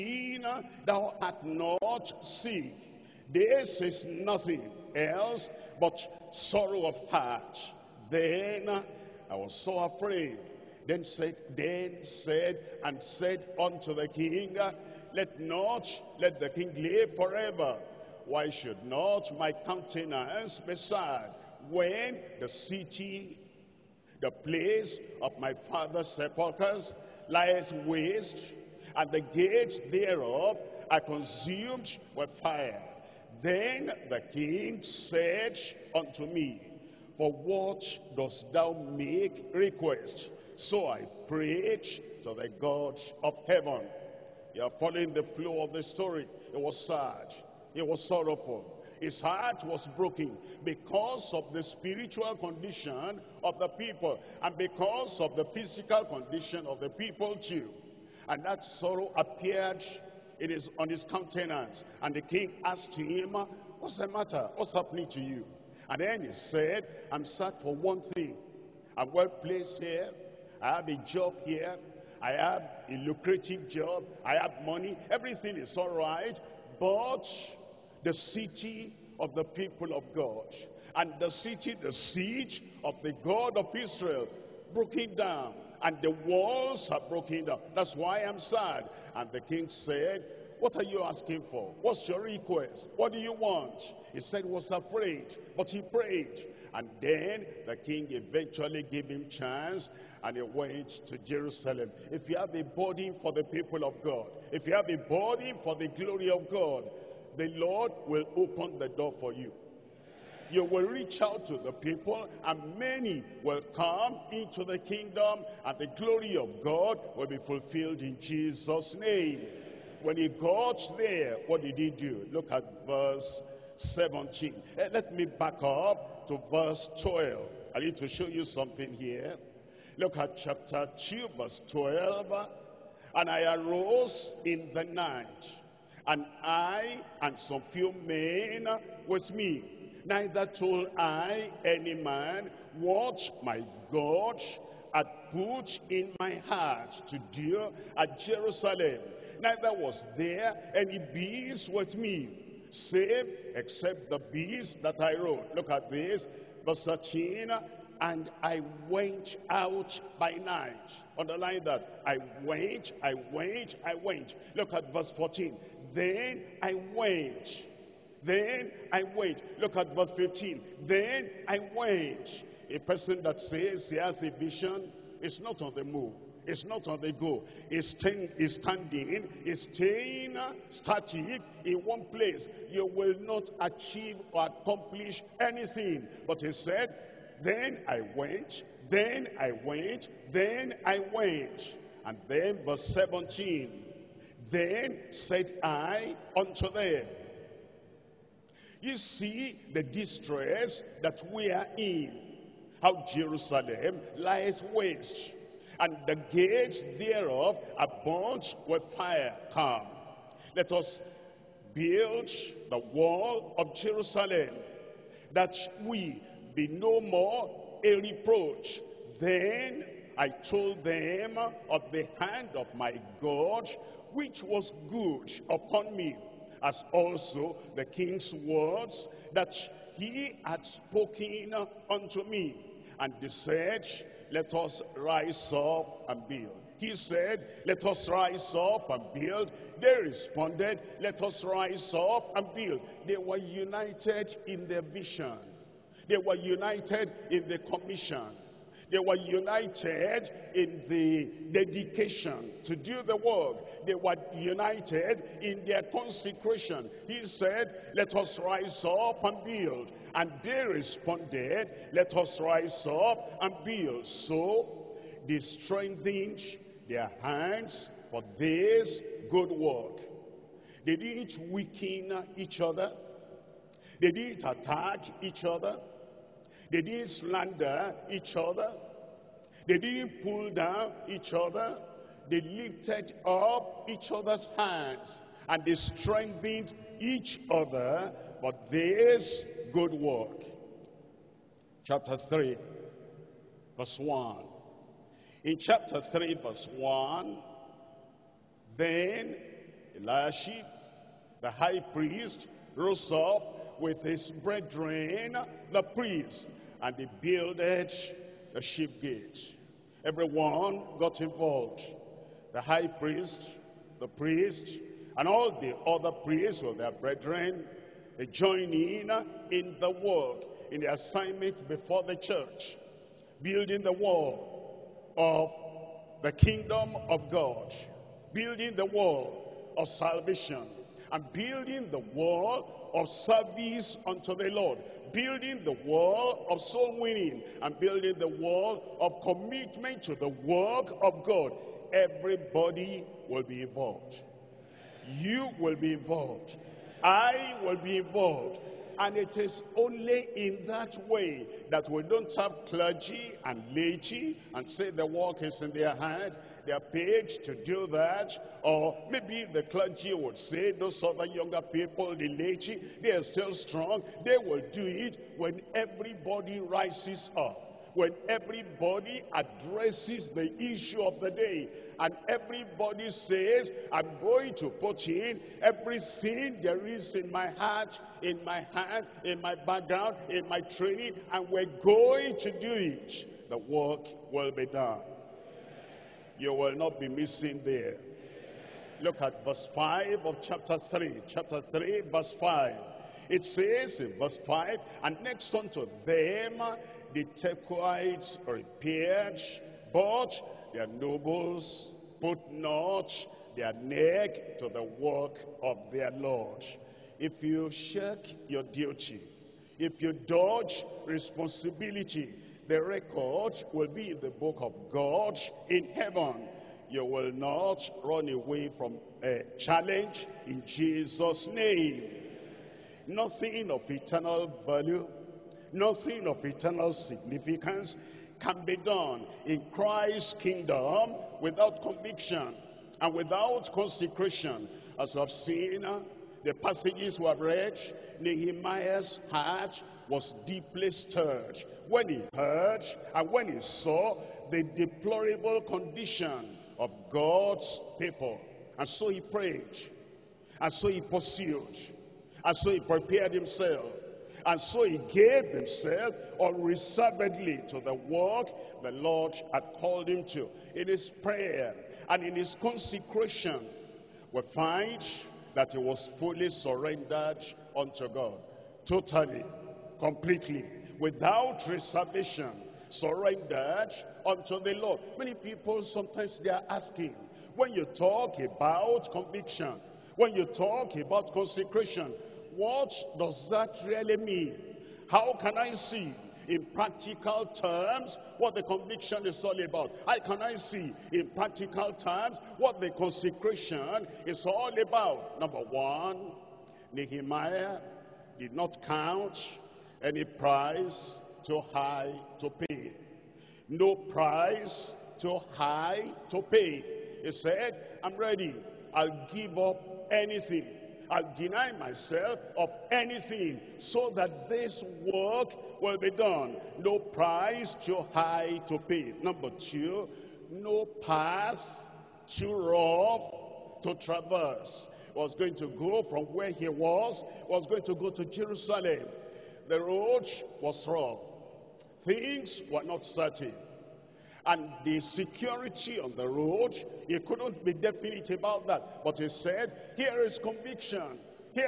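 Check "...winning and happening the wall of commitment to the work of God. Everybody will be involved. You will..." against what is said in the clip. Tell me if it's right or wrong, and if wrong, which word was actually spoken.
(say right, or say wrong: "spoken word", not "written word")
wrong: "building", not "happening".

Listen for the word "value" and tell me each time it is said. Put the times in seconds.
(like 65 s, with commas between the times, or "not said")
424 s.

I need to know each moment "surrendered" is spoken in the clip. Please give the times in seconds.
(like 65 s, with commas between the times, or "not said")
466 s, 472 s.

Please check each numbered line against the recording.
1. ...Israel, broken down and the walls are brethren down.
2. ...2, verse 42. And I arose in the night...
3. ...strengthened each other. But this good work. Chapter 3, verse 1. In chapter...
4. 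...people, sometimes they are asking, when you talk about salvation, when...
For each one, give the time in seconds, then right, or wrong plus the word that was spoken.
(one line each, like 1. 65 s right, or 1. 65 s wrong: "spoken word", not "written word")
1. 83 s wrong: "broken", not "brethren"
2. 130 s wrong: "12", not "42"
3. 285 s right
4. 475 s wrong: "conviction", not "salvation".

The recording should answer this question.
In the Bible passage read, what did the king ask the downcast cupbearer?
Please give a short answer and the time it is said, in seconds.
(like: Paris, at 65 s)
For what dost thou make request?, at 37 s.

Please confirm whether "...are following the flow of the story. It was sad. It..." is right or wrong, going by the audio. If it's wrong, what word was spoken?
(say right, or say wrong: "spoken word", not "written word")
right.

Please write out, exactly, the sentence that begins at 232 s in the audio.
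And they said, let us rise up and build.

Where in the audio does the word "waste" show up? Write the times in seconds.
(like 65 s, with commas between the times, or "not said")
27 s, 204 s.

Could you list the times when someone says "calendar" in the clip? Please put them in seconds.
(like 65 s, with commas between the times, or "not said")
not said.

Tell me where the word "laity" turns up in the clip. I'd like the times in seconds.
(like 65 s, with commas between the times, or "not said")
353 s, 362 s.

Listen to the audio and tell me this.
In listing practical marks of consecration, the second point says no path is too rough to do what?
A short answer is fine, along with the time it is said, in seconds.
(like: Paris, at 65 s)
Traverse, at 523 s.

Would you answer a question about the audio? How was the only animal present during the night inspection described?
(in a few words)
The beast that I rode.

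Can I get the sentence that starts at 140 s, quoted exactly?
Neither told I any man what my God had put in my heart to do at Jerusalem.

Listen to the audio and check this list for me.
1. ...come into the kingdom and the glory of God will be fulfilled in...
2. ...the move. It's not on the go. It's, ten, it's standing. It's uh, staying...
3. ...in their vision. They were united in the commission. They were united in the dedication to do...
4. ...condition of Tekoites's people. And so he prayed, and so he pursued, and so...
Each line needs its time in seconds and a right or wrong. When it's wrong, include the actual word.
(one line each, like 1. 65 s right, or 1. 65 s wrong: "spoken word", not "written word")
1. 113 s right
2. 175 s right
3. 244 s right
4. 445 s wrong: "God", not "Tekoites".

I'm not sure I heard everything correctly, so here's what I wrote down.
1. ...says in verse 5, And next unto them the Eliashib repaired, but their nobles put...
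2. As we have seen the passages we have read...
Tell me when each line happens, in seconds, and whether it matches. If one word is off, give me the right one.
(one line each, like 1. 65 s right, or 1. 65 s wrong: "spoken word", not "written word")
1. 393 s wrong: "Tekoites", not "Eliashib"
2. 434 s right.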